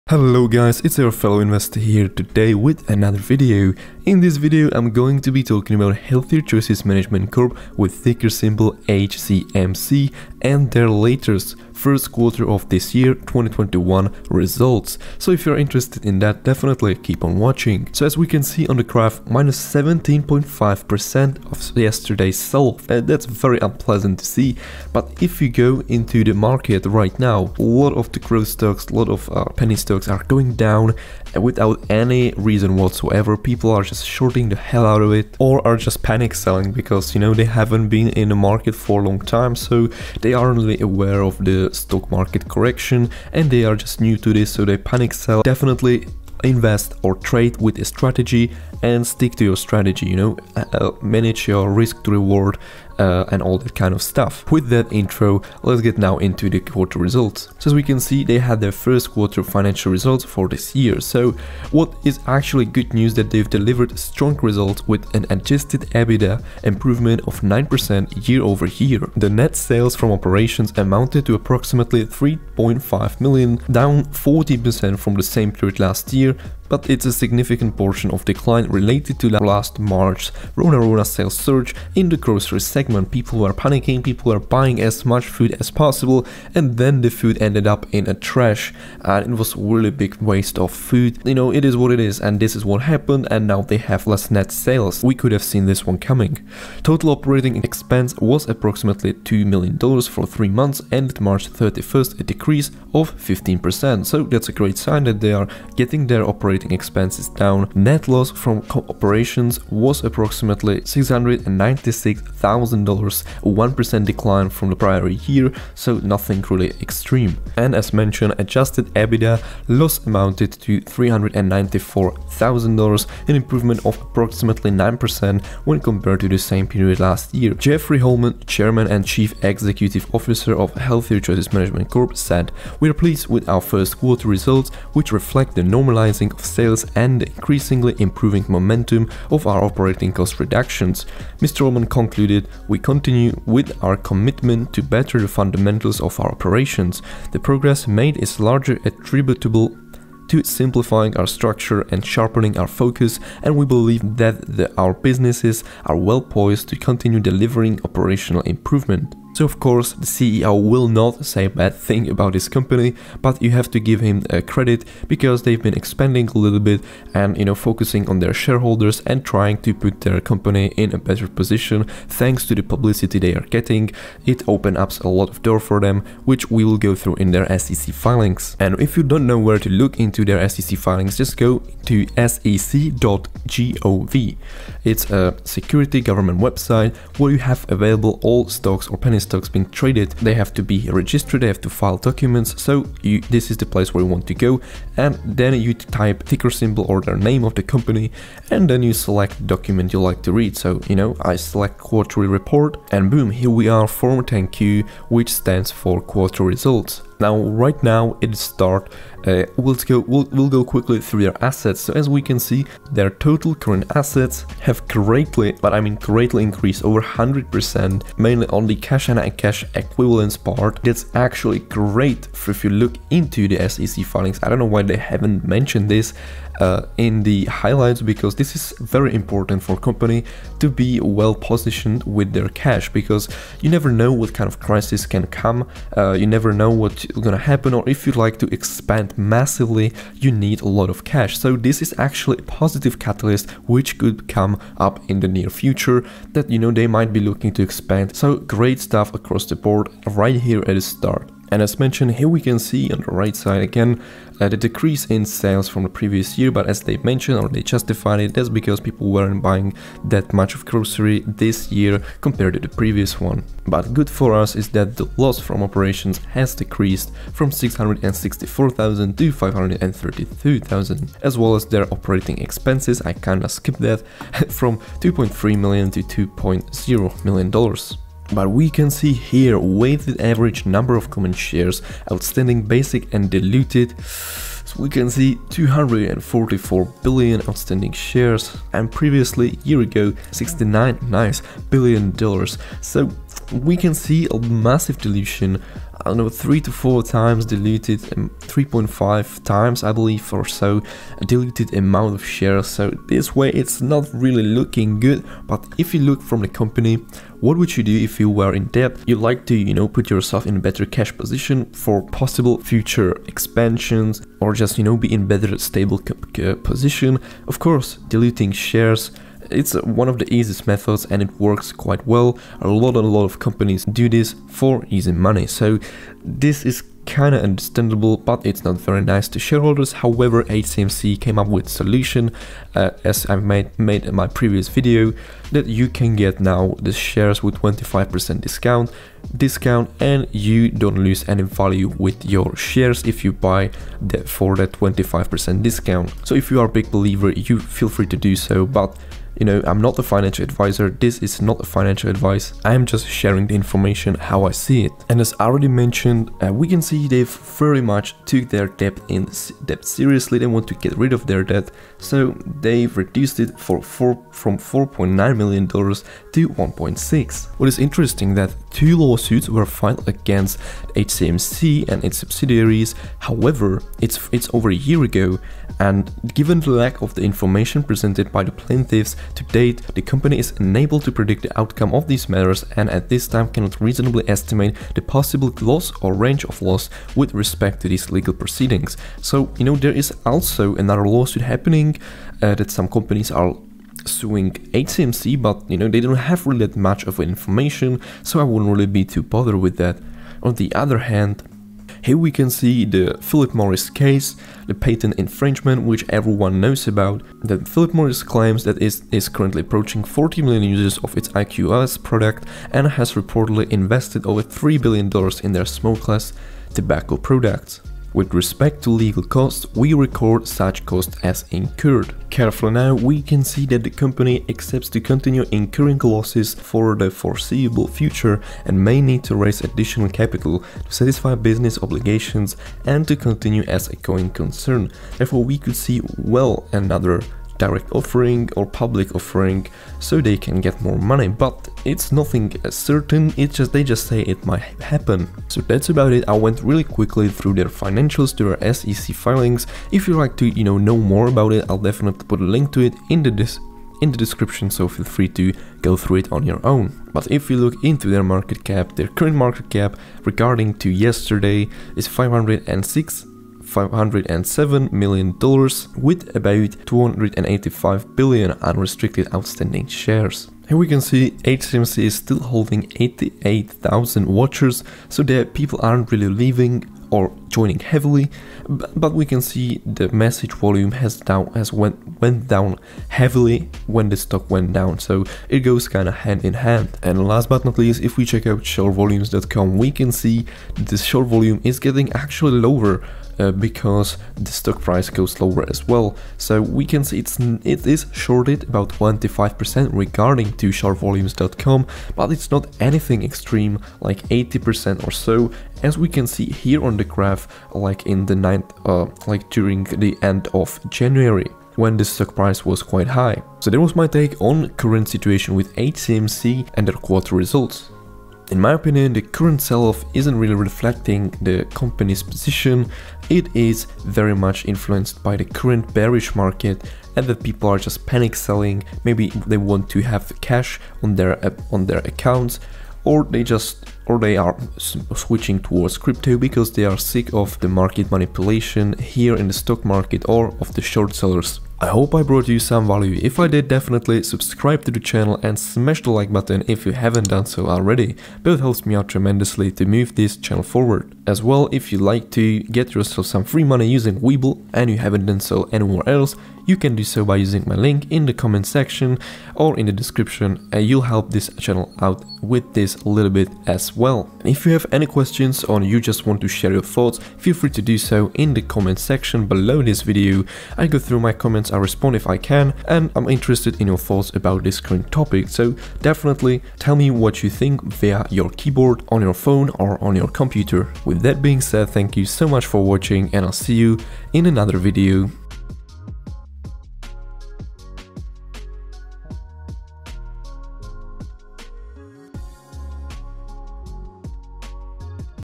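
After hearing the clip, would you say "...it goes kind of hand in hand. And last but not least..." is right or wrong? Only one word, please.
right.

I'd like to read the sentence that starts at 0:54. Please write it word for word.
With that intro, let's get now into the quarter results.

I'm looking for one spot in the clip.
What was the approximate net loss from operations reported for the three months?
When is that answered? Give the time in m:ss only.
1:50.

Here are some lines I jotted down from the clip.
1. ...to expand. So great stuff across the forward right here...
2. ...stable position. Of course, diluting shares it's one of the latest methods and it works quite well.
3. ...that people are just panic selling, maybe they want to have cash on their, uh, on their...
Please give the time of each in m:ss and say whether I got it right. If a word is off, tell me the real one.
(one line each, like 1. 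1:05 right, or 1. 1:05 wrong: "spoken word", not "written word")
1. 4:07 wrong: "board", not "forward"
2. 5:15 wrong: "easiest", not "latest"
3. 8:47 right.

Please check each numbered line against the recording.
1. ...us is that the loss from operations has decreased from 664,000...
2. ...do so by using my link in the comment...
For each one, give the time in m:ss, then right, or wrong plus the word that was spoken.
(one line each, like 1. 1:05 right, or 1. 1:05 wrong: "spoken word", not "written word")
1. 4:24 right
2. 9:16 right.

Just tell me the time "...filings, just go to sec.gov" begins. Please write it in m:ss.
3:00.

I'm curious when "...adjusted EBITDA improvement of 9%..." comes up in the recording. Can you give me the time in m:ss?
1:05.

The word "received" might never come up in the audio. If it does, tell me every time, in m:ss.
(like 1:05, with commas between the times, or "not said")
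not said.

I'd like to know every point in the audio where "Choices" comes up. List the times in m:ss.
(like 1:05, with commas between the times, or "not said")
0:06, 2:11.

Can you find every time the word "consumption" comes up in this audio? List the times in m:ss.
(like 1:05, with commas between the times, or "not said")
not said.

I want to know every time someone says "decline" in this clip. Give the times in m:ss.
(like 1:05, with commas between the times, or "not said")
1:18, 1:54.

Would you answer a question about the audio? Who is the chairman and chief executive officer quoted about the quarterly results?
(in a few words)
Jeffrey Holman.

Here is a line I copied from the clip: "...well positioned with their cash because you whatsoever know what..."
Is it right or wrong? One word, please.
wrong.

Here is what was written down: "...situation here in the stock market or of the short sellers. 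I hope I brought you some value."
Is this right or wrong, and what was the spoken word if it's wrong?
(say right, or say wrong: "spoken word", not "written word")
wrong: "manipulation", not "situation".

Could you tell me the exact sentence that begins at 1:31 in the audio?
You know, it is what it is, and this is what happened, and now they have less net sales.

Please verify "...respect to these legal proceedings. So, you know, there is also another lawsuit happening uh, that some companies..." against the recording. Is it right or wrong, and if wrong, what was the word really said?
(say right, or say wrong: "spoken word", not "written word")
right.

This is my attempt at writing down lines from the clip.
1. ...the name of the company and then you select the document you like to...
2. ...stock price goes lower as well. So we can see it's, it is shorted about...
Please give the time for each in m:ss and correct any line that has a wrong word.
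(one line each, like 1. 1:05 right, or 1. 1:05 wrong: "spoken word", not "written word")
1. 3:17 right
2. 8:14 right.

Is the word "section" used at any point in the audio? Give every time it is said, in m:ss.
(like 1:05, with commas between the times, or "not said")
9:18, 9:28.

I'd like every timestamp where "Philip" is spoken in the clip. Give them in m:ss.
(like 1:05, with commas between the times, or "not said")
6:43, 6:47.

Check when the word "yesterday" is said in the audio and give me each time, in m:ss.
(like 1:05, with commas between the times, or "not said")
0:21, 7:40.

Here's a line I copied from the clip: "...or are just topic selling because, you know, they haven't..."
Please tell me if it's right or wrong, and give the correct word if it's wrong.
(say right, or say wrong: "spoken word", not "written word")
wrong: "panic", not "topic".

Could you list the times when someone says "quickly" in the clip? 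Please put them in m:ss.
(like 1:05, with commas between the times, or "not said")
3:30, 7:26.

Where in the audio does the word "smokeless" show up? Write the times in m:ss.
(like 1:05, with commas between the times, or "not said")
6:55.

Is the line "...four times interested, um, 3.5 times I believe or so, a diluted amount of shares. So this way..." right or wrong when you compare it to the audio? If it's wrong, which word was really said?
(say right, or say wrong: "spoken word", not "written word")
wrong: "diluted", not "interested".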